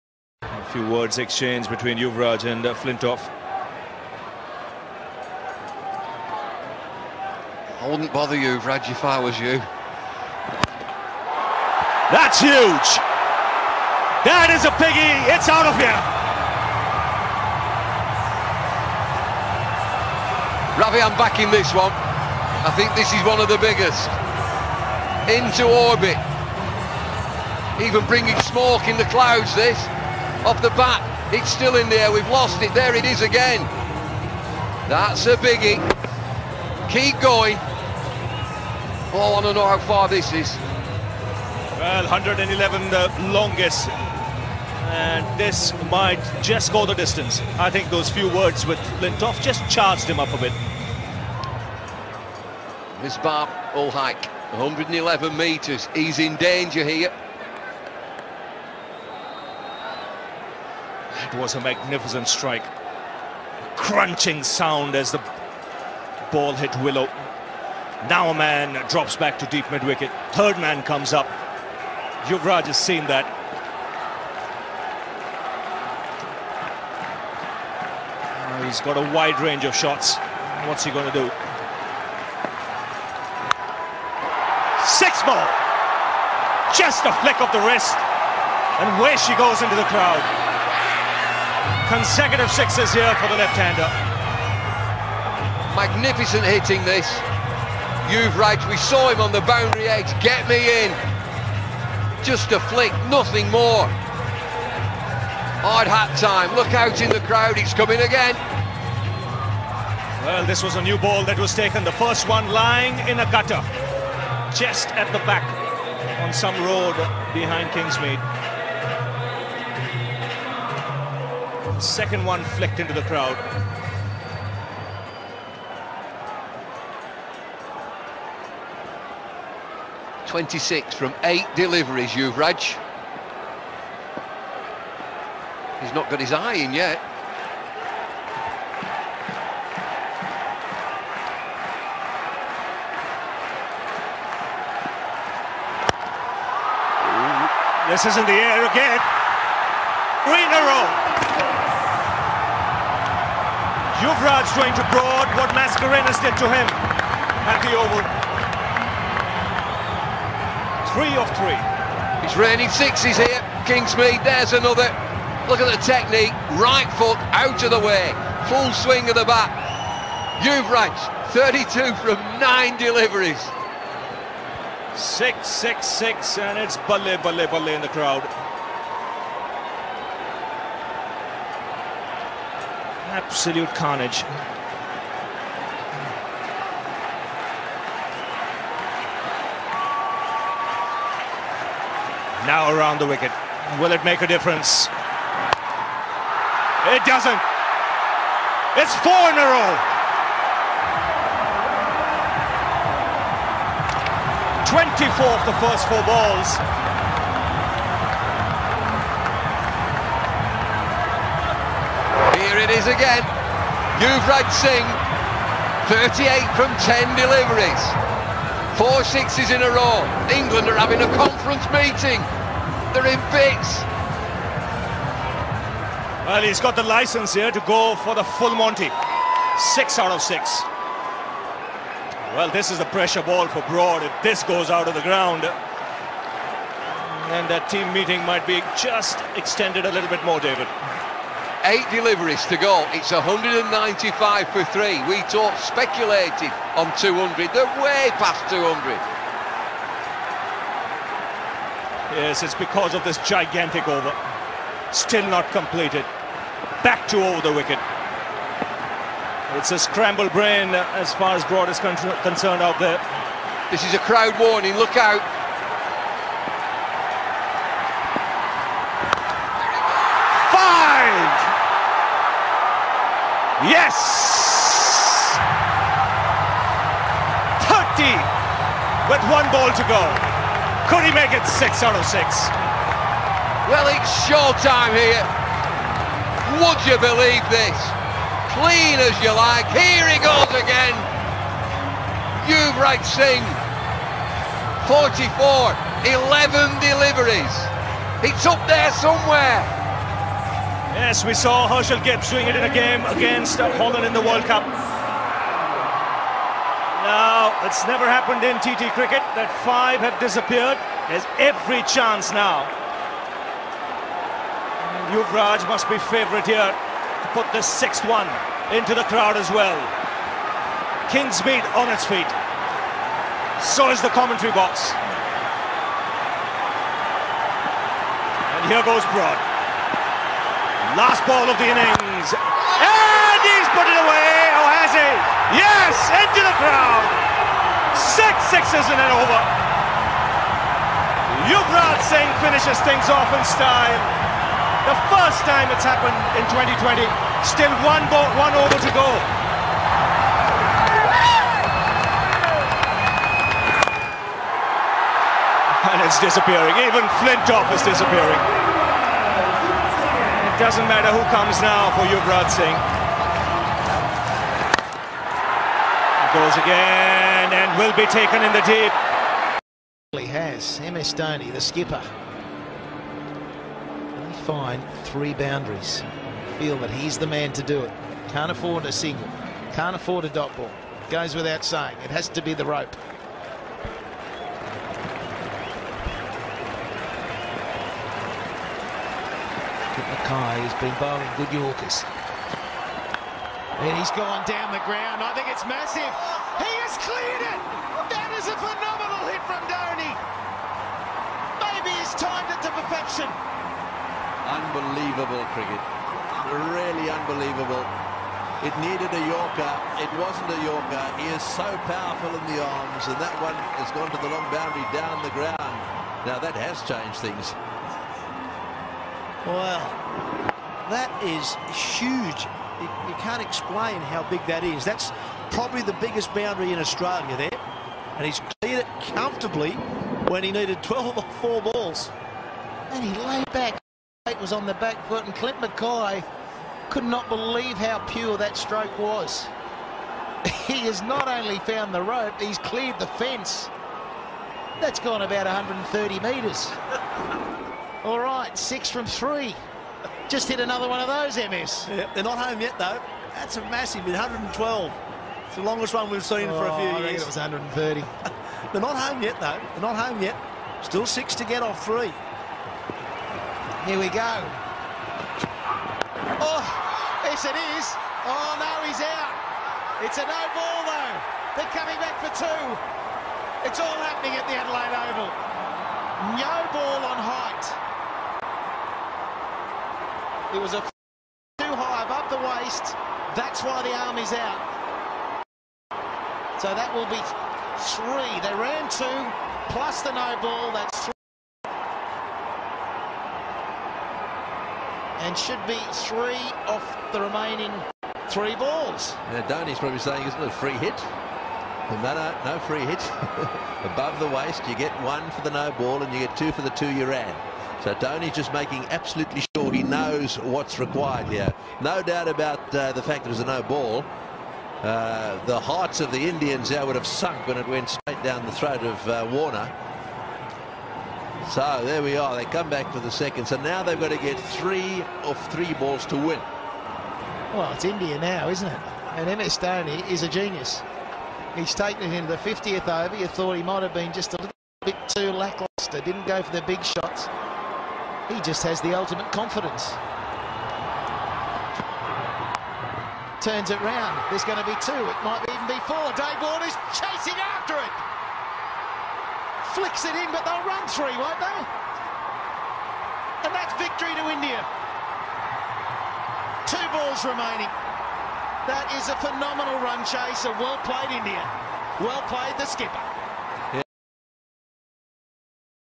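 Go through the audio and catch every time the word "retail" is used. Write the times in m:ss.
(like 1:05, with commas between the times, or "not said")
not said.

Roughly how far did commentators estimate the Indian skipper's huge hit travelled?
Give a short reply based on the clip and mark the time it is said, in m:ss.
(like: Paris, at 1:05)
130 metres, at 7:25.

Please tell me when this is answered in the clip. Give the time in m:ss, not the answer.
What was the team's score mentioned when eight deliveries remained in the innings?
4:03.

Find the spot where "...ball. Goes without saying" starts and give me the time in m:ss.
6:20.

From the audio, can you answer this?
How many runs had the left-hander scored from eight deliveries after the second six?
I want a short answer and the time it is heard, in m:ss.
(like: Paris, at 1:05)
26, at 2:10.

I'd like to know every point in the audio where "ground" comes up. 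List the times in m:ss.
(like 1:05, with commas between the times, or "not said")
3:55, 6:34, 6:55.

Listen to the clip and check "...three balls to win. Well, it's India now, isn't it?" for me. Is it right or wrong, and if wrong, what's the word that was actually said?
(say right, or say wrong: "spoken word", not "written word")
right.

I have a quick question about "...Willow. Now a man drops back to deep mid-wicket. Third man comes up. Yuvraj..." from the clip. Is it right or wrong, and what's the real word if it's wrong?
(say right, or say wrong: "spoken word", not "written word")
right.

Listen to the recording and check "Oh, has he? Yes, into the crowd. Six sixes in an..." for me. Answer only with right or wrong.
right.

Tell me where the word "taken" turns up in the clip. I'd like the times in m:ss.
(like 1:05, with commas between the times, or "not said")
1:51, 6:08, 8:51.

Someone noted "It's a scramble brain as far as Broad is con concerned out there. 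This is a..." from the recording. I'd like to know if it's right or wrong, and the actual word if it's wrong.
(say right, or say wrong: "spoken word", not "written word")
right.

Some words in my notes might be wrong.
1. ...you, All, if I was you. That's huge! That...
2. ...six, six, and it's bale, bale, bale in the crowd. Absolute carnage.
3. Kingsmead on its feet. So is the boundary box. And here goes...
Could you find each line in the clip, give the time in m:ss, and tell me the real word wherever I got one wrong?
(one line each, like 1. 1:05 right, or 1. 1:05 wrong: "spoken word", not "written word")
1. 0:08 wrong: "Raj", not "All"
2. 2:55 right
3. 5:21 wrong: "commentary", not "boundary".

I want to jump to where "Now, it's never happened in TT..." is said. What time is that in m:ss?
5:04.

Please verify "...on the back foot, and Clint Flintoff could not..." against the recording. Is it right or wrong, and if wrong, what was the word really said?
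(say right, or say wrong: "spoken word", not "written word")
wrong: "McKay", not "Flintoff".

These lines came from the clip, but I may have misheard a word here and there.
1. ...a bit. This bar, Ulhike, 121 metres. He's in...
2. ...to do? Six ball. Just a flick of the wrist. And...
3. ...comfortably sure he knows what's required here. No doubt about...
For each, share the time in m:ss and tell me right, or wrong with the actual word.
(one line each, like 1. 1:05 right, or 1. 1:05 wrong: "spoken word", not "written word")
1. 0:50 wrong: "111", not "121"
2. 1:21 right
3. 8:28 wrong: "absolutely", not "comfortably".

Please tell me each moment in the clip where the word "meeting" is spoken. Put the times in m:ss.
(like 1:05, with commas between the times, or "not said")
3:41, 3:57.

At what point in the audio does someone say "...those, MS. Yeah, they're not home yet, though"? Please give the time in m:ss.
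7:31.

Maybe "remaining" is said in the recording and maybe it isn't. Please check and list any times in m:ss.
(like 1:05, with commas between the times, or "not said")
8:17, 9:17.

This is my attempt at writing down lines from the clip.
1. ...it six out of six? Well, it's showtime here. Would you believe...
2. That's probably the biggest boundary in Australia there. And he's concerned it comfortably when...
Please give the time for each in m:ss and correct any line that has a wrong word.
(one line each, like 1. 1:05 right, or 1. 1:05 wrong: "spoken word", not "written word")
1. 4:41 right
2. 7:04 wrong: "cleared", not "concerned".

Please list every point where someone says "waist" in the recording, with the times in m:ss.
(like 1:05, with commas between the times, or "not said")
8:02, 8:24.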